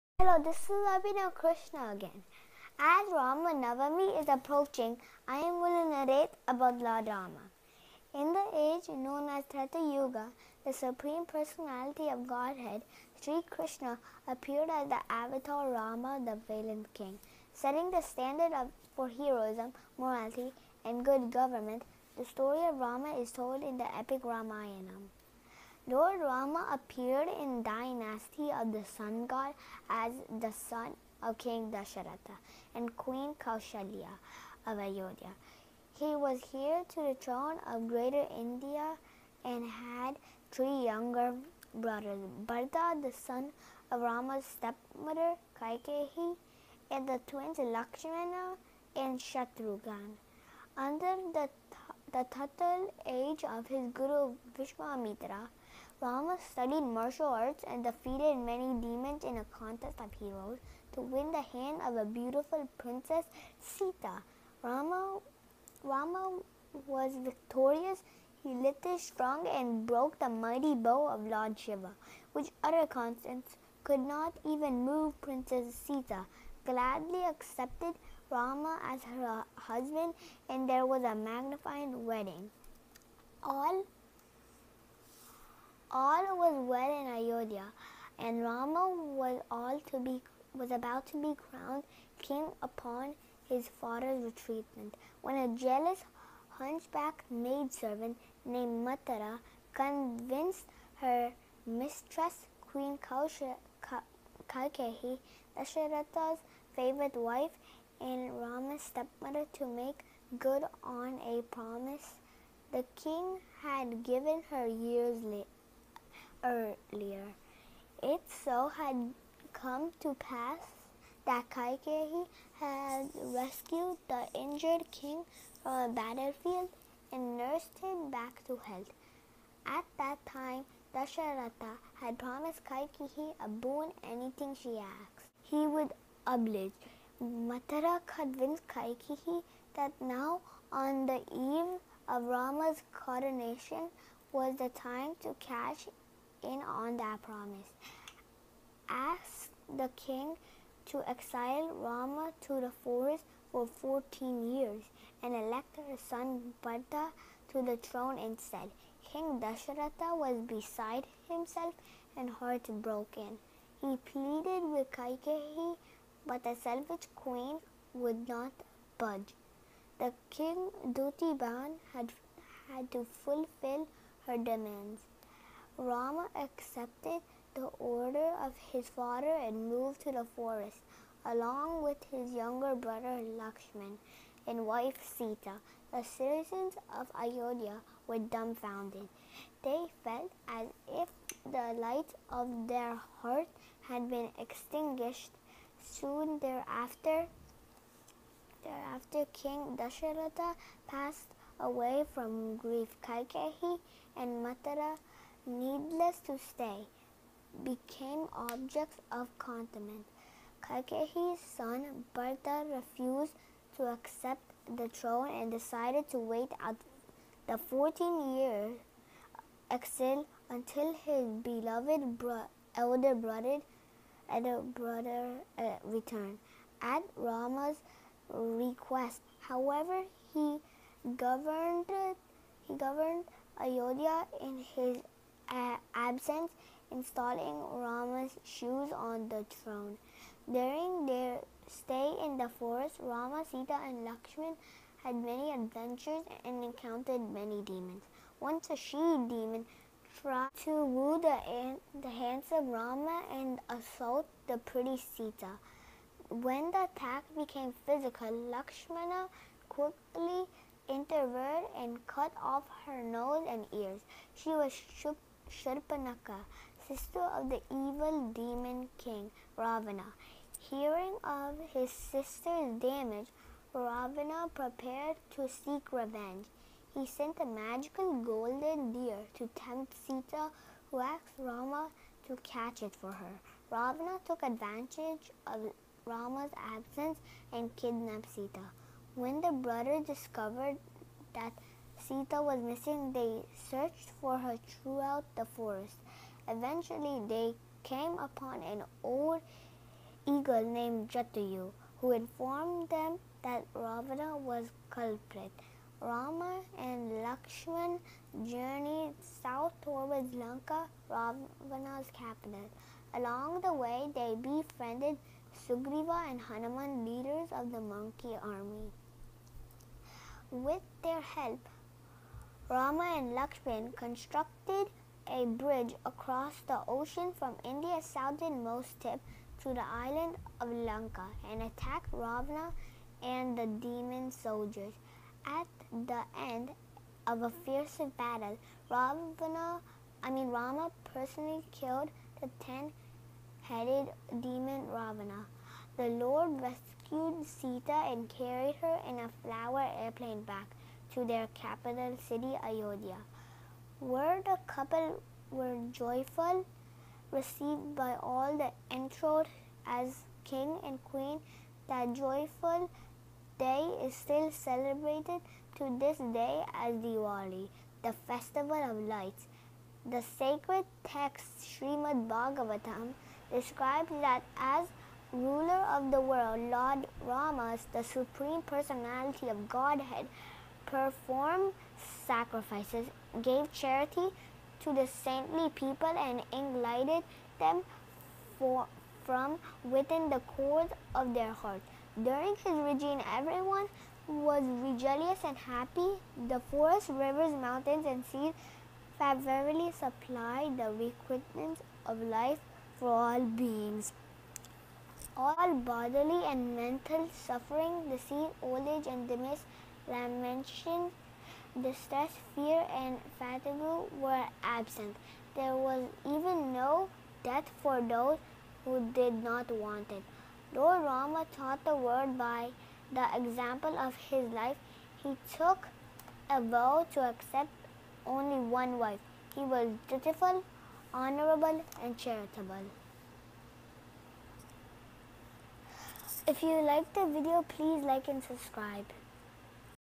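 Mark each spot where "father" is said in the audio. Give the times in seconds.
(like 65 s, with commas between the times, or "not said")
93 s, 178 s.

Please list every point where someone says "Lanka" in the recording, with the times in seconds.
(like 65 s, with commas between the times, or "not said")
310 s, 330 s.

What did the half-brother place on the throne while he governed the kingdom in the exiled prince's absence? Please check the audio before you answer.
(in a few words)
Rama's shoes.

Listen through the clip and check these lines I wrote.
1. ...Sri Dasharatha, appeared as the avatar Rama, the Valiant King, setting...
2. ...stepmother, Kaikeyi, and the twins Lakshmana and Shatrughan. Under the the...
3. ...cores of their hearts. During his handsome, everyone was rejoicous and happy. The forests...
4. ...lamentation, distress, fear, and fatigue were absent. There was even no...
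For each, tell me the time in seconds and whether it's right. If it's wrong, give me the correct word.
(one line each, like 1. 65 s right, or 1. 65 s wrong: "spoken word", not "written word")
1. 13 s wrong: "Krishna", not "Dasharatha"
2. 44 s right
3. 390 s wrong: "regime", not "handsome"
4. 410 s right.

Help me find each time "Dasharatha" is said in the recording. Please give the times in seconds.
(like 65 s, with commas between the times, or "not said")
31 s, 105 s, 130 s, 159 s, 199 s.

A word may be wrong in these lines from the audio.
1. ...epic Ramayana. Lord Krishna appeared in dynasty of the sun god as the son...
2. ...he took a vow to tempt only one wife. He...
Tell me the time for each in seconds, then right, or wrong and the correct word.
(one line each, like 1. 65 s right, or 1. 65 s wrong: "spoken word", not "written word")
1. 23 s wrong: "Rama", not "Krishna"
2. 425 s wrong: "accept", not "tempt".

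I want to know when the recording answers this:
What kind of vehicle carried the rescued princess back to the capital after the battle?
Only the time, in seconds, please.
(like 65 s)
349 s.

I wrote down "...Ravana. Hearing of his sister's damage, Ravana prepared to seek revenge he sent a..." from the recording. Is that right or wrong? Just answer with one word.
right.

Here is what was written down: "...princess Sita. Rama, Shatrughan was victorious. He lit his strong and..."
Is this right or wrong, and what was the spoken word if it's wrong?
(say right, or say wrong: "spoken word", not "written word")
wrong: "Rama", not "Shatrughan".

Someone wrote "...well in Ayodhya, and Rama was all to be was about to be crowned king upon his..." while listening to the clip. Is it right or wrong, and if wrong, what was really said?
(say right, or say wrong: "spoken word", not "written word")
right.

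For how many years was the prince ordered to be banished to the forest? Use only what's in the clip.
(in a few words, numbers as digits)
14.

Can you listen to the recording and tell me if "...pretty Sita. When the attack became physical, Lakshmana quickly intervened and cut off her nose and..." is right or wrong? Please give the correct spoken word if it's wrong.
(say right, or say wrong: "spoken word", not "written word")
right.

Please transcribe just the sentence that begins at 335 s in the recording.
At the end of a fierce battle, Ravana, I mean Rama personally killed the ten-headed demon Ravana.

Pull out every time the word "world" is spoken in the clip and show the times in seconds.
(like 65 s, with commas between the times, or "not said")
376 s, 421 s.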